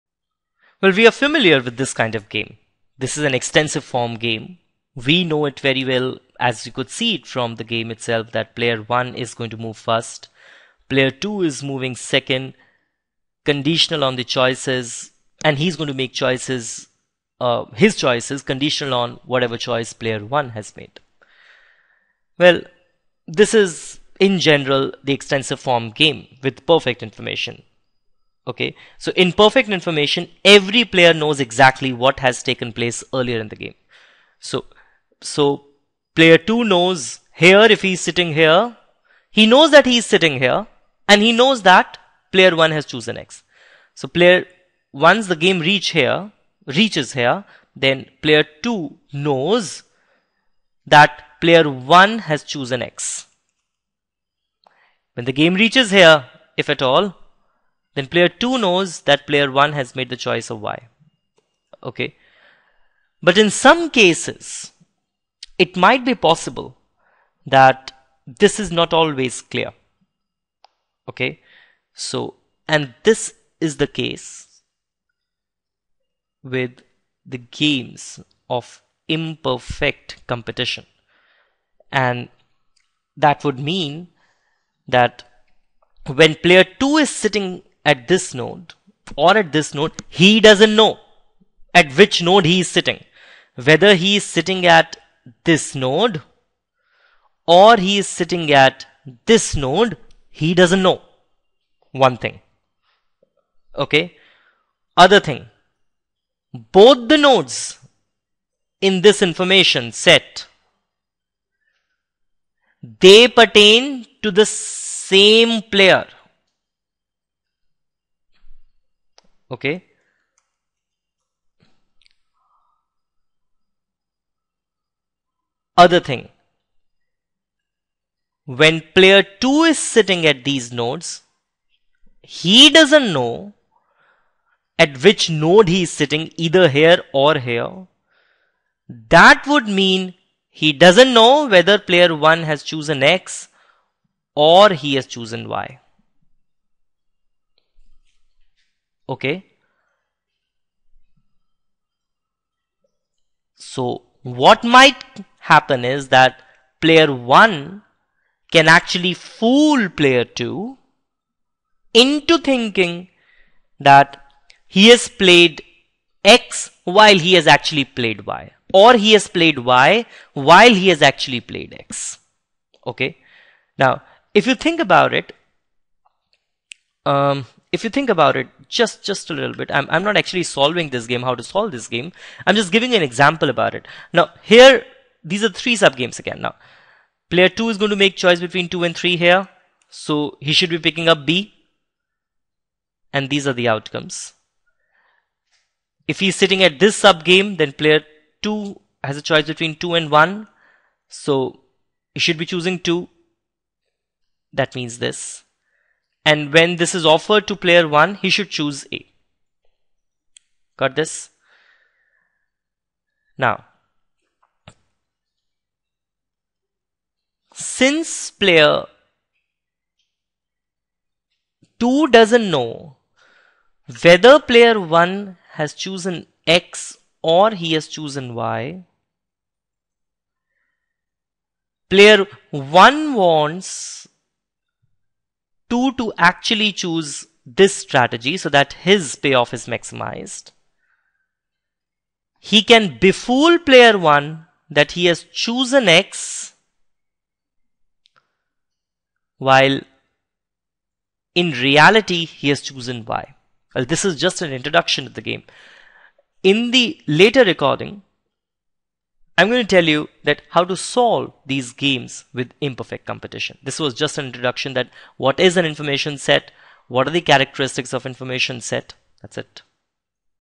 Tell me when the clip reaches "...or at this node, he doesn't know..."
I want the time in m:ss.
1:29.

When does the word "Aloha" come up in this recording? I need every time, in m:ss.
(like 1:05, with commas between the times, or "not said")
not said.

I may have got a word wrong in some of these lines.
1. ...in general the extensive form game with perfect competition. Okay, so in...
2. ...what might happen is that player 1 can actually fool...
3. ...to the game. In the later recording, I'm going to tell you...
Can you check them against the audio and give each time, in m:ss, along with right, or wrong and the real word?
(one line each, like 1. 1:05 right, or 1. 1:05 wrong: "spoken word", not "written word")
1. 0:24 wrong: "information", not "competition"
2. 2:34 right
3. 4:15 right.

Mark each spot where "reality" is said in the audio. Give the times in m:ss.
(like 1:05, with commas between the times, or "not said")
4:11.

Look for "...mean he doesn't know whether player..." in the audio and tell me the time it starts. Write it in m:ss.
2:19.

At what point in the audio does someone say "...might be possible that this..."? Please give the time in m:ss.
1:05.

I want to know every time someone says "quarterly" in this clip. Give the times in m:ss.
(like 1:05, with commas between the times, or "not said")
not said.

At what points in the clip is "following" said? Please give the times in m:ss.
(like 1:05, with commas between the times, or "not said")
not said.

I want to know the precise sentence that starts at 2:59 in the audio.
I'm, I'm not actually solving this game, how to solve this game.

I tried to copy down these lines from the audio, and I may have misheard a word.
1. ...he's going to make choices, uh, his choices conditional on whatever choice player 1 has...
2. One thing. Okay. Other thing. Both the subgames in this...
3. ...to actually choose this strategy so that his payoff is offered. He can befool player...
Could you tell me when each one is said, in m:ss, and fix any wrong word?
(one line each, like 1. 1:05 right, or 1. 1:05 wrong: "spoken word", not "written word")
1. 0:15 right
2. 1:41 wrong: "nodes", not "subgames"
3. 3:55 wrong: "maximized", not "offered".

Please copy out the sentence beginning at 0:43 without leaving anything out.
So player, once the game reach here, reaches here, then player 2 knows that player 1 has chosen X.